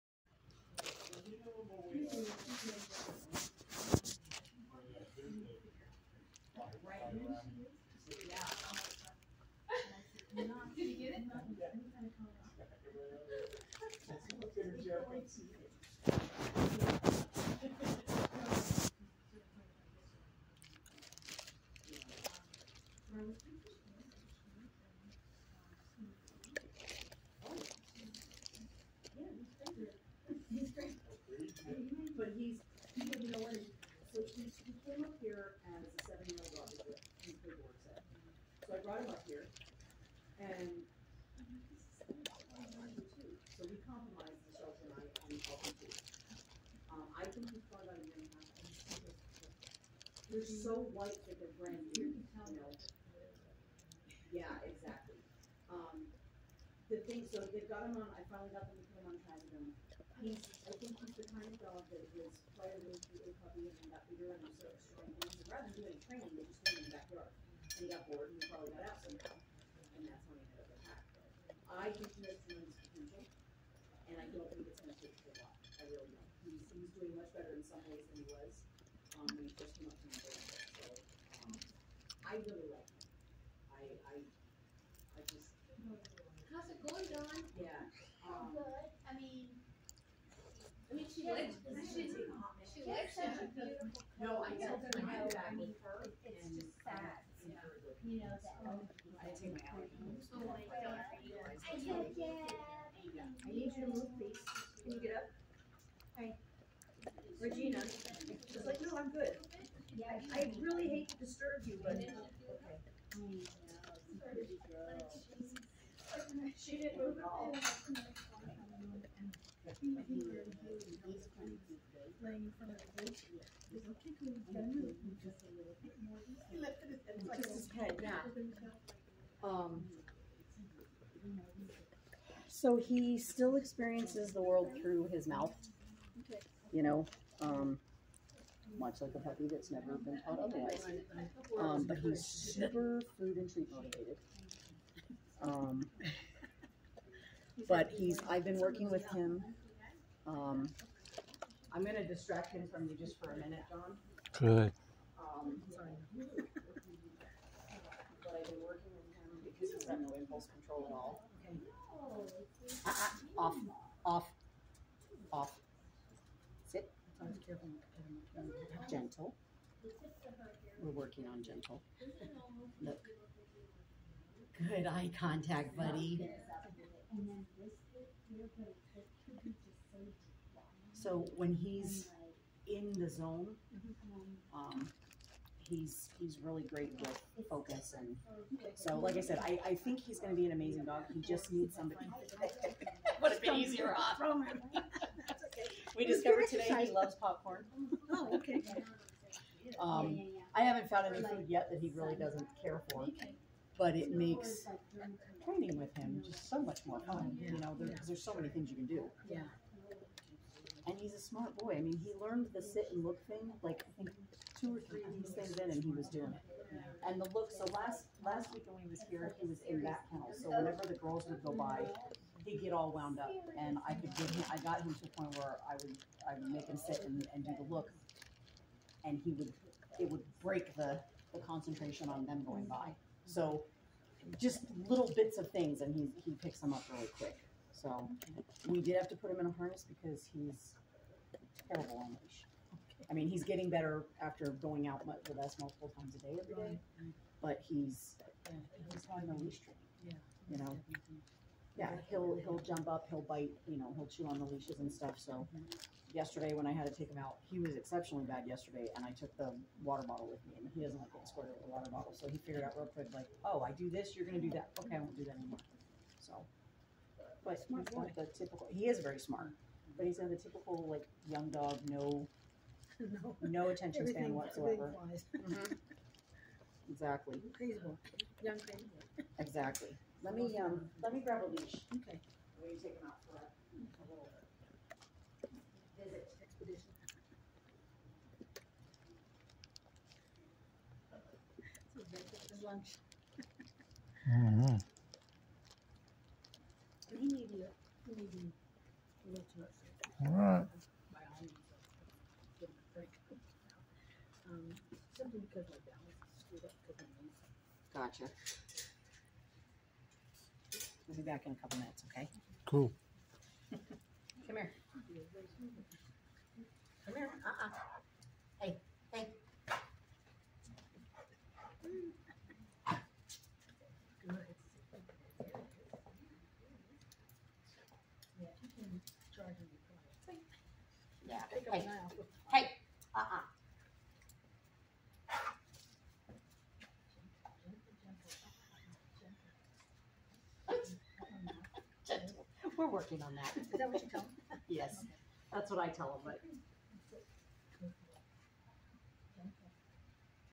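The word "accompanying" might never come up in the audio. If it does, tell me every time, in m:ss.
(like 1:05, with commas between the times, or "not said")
not said.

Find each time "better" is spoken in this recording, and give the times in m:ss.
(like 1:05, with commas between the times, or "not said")
1:17, 4:03.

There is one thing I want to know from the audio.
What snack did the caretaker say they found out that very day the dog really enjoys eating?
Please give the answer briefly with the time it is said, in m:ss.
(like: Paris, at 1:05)
Popcorn, at 3:17.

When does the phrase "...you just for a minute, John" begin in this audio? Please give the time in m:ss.
2:32.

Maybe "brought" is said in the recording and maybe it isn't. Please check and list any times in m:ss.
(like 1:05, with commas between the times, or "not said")
0:38.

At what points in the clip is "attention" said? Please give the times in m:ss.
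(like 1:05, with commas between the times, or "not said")
4:33.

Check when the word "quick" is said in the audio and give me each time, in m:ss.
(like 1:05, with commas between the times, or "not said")
3:57, 4:22.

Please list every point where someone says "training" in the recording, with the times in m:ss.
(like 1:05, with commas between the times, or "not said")
1:06, 3:25, 4:09.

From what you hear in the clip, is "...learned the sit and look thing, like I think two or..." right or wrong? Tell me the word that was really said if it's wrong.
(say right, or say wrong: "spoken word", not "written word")
right.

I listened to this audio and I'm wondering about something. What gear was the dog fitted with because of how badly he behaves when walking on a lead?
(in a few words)
A harness.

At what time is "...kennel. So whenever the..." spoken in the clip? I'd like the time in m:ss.
3:40.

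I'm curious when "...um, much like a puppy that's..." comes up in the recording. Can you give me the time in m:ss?
2:17.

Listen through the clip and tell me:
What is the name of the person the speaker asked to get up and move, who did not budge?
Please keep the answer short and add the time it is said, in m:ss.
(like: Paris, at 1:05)
Regina, at 1:47.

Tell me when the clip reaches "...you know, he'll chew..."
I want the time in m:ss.
4:13.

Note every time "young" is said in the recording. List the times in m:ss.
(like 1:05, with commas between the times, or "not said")
4:31, 4:38.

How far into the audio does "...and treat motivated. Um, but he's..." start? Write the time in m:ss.
2:23.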